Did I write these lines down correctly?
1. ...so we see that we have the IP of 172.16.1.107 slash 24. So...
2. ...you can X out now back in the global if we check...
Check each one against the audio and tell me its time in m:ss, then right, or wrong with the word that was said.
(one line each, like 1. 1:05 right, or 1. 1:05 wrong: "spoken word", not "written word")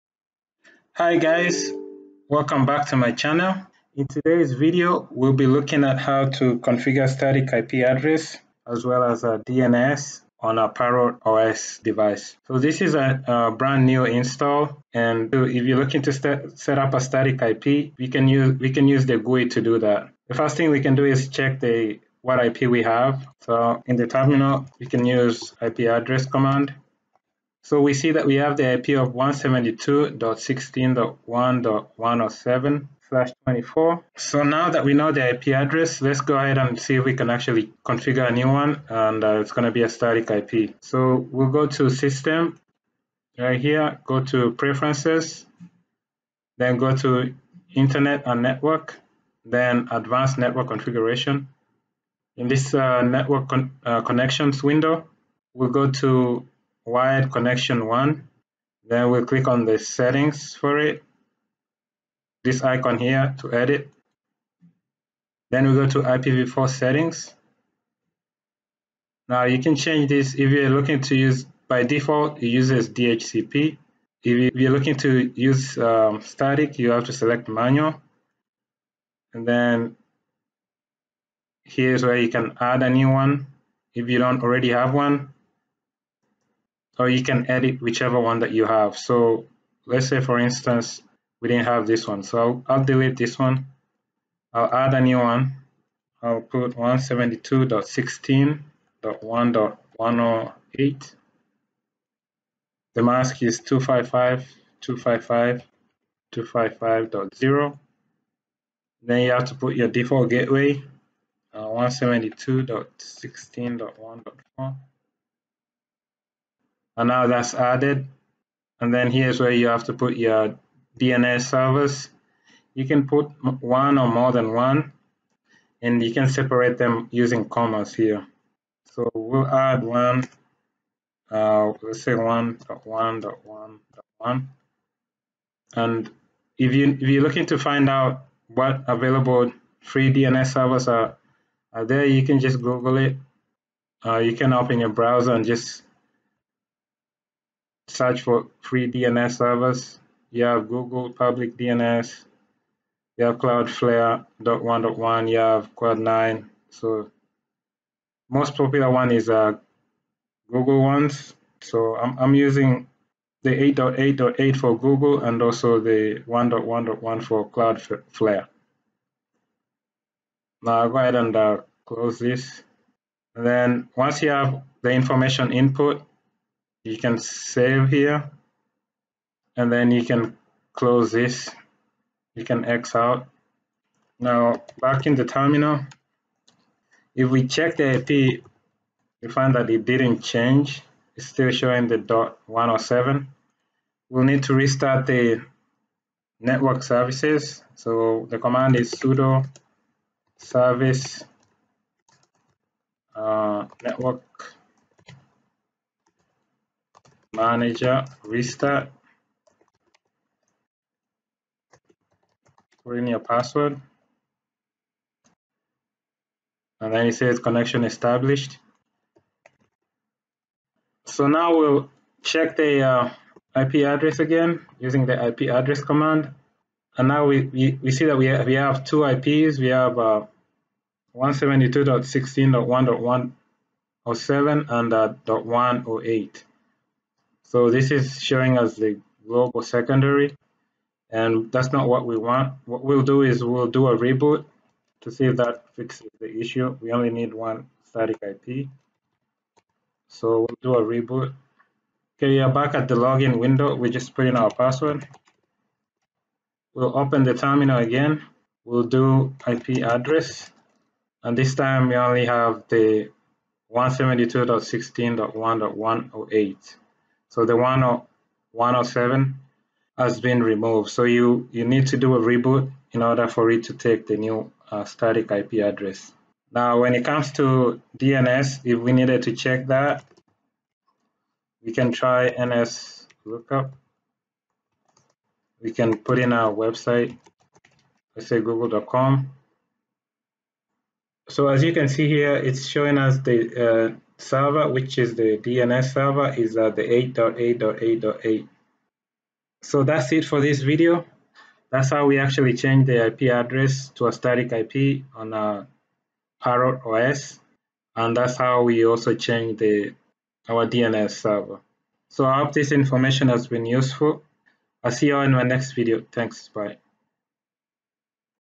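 1. 0:27 right
2. 3:02 wrong: "terminal", not "global".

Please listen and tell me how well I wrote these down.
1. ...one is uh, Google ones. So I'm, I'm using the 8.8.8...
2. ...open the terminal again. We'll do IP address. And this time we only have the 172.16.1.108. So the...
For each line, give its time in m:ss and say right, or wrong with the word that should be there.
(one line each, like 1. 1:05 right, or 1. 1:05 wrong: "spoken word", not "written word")
1. 2:38 right
2. 4:16 right.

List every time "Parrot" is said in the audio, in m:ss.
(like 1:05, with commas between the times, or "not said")
0:10, 5:06.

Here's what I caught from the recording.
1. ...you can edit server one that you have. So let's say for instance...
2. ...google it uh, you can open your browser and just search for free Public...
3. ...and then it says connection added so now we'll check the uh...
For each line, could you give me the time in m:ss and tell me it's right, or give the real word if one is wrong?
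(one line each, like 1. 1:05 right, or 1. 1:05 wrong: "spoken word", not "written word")
1. 1:27 wrong: "whichever", not "server"
2. 2:22 wrong: "DNS", not "Public"
3. 3:36 wrong: "established", not "added".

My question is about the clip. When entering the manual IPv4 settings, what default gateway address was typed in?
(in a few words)
172.16.1.4.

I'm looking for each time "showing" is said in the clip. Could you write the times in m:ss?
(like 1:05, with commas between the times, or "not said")
3:11, 3:58, 4:52.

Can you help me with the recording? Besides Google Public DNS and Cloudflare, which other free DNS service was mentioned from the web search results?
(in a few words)
Quad9.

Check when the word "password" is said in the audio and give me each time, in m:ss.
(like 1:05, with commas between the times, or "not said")
3:33, 4:14.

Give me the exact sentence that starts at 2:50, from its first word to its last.
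Now I'll go ahead and uh, close this.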